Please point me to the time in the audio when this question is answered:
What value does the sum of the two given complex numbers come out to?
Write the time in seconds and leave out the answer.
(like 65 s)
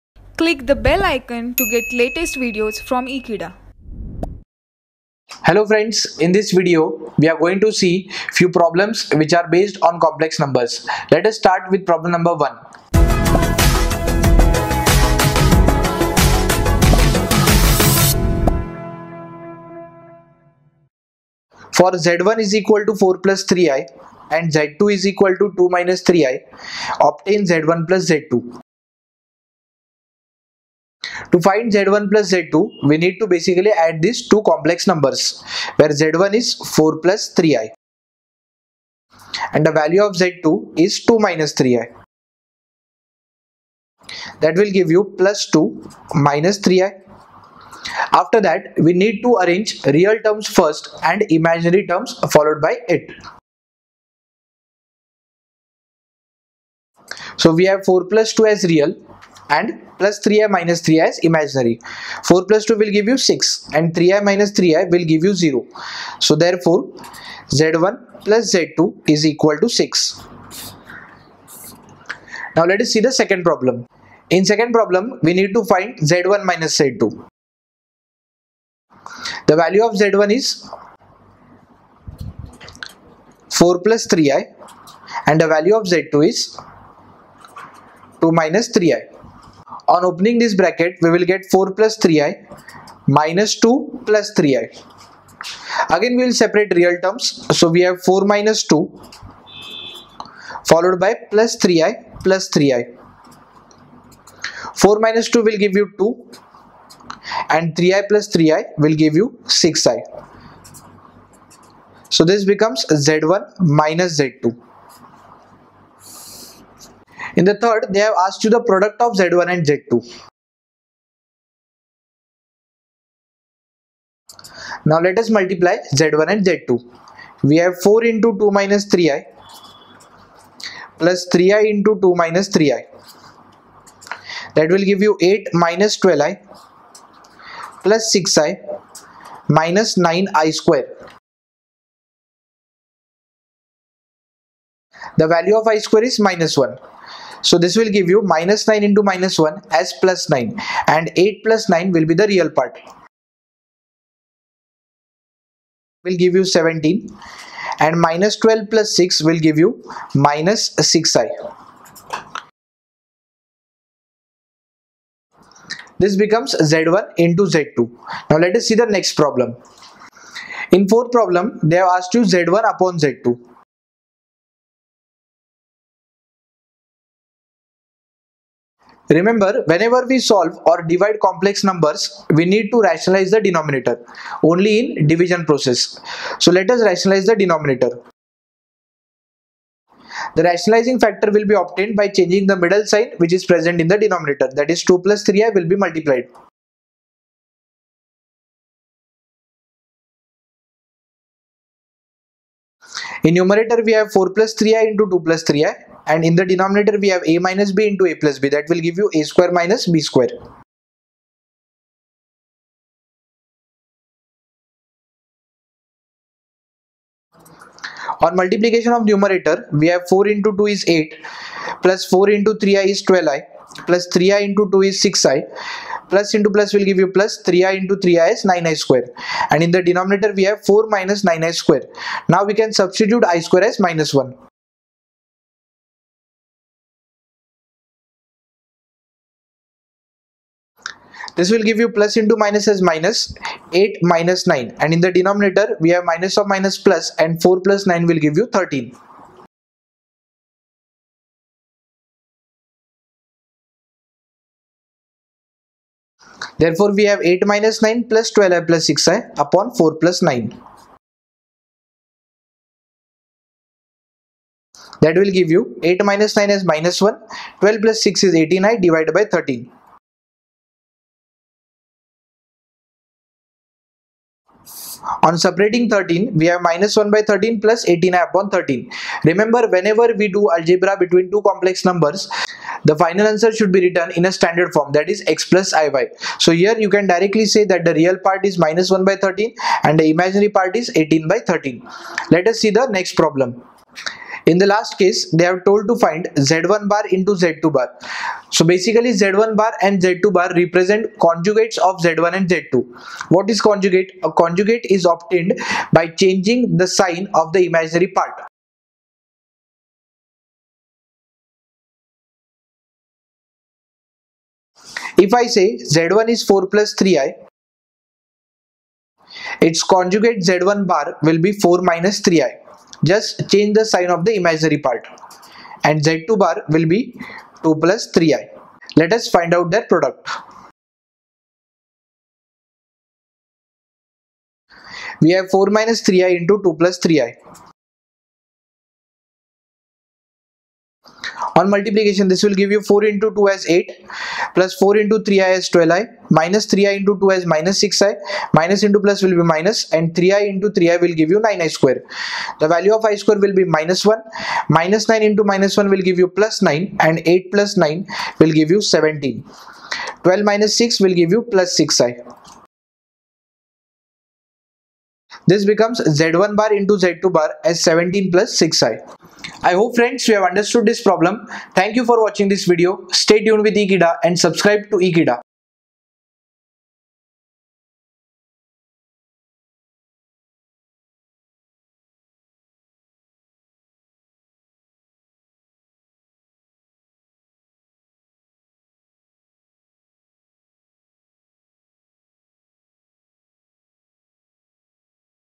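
67 s.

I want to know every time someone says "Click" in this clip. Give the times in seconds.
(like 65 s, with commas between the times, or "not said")
0 s.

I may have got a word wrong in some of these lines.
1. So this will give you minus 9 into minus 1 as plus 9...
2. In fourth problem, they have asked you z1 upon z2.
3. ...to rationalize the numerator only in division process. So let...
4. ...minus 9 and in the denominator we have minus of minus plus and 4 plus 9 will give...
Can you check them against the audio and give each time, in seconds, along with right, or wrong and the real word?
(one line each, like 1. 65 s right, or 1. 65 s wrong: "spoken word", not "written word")
1. 147 s right
2. 170 s right
3. 182 s wrong: "denominator", not "numerator"
4. 244 s right.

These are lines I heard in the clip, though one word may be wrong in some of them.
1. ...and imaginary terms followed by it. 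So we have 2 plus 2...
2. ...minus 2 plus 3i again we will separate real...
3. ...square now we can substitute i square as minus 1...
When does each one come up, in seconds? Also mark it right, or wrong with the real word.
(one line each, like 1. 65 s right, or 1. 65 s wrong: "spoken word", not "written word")
1. 51 s wrong: "4", not "2"
2. 93 s right
3. 231 s right.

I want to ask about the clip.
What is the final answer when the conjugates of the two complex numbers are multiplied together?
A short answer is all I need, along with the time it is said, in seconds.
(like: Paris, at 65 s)
17 + 6i, at 367 s.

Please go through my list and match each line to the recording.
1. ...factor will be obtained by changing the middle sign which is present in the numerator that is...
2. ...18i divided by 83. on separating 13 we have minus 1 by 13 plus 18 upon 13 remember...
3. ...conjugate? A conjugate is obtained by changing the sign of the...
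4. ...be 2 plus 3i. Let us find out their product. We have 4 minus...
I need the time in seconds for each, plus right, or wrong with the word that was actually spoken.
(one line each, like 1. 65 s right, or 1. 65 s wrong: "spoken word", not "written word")
1. 190 s wrong: "denominator", not "numerator"
2. 268 s wrong: "13", not "83"
3. 303 s right
4. 326 s right.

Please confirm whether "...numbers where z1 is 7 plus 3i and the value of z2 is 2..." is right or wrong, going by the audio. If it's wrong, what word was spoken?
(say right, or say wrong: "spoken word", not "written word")
wrong: "4", not "7".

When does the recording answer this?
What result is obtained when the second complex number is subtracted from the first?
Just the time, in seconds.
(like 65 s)
106 s.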